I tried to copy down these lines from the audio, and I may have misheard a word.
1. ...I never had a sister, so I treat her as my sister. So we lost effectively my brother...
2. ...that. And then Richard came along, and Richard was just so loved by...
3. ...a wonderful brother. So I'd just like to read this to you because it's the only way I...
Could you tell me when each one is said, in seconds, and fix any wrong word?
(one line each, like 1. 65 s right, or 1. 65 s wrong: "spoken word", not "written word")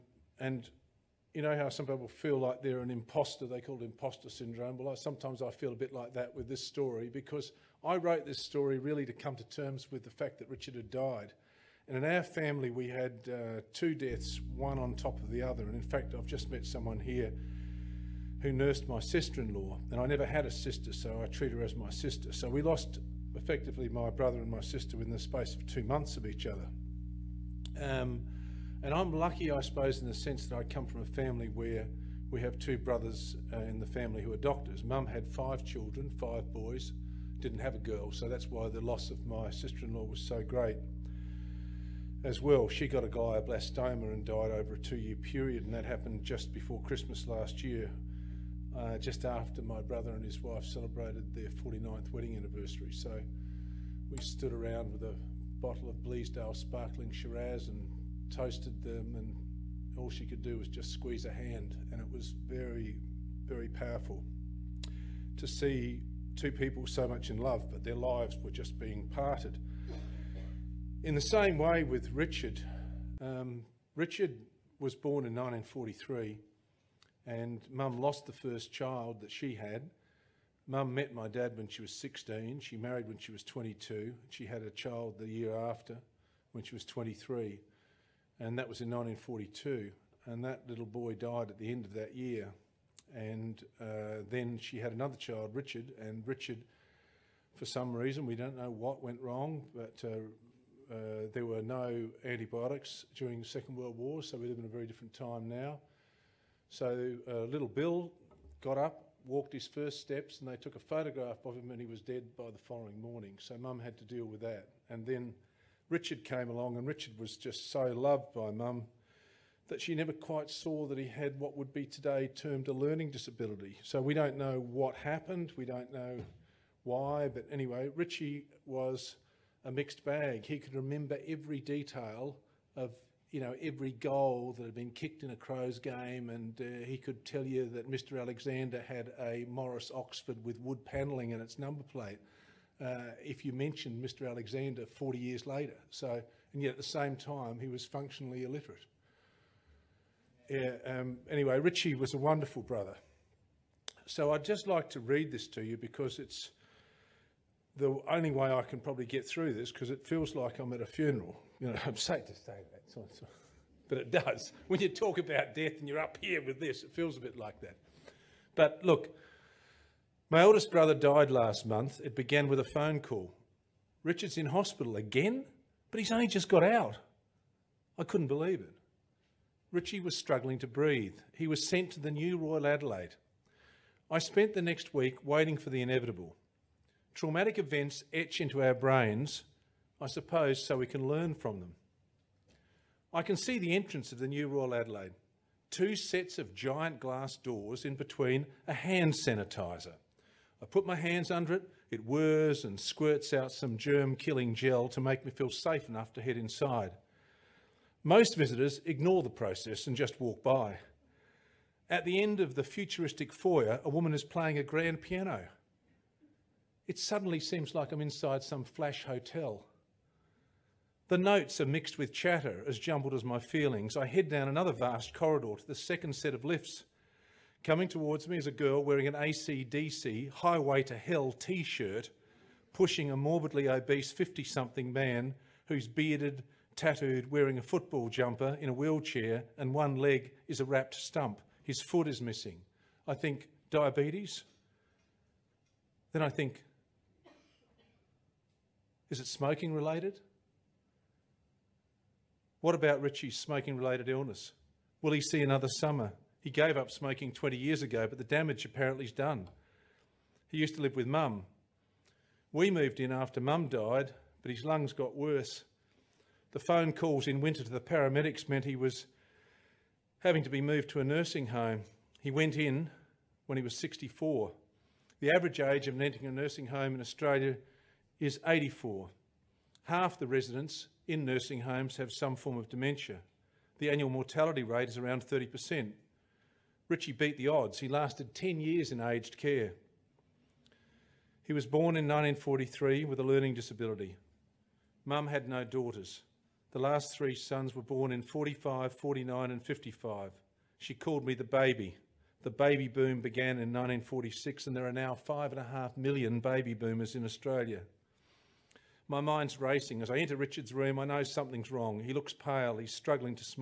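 1. 19 s right
2. 114 s right
3. 152 s right.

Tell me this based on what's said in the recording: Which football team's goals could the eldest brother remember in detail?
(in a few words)
Crows.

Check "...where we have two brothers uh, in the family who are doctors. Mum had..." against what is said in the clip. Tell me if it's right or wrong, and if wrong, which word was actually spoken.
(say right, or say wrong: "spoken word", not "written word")
right.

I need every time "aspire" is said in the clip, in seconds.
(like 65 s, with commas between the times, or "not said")
not said.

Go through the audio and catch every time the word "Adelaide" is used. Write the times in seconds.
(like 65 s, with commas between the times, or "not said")
182 s, 194 s.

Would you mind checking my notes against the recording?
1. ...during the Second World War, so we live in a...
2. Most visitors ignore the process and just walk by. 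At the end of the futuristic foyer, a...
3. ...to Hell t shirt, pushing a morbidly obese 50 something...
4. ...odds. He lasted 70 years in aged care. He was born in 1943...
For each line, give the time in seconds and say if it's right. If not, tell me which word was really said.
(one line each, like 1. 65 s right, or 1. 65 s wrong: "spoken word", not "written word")
1. 103 s right
2. 208 s right
3. 230 s right
4. 287 s wrong: "10", not "70".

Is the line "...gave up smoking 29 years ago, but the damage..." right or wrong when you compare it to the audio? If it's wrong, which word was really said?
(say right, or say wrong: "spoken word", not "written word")
wrong: "20", not "29".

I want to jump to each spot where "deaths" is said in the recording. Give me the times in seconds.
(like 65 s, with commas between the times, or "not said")
13 s, 165 s.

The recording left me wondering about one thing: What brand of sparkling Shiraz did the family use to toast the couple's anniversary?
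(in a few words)
Bleasdale.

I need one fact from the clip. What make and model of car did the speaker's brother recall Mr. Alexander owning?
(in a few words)
Morris Oxford.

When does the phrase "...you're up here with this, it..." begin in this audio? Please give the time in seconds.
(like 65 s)
165 s.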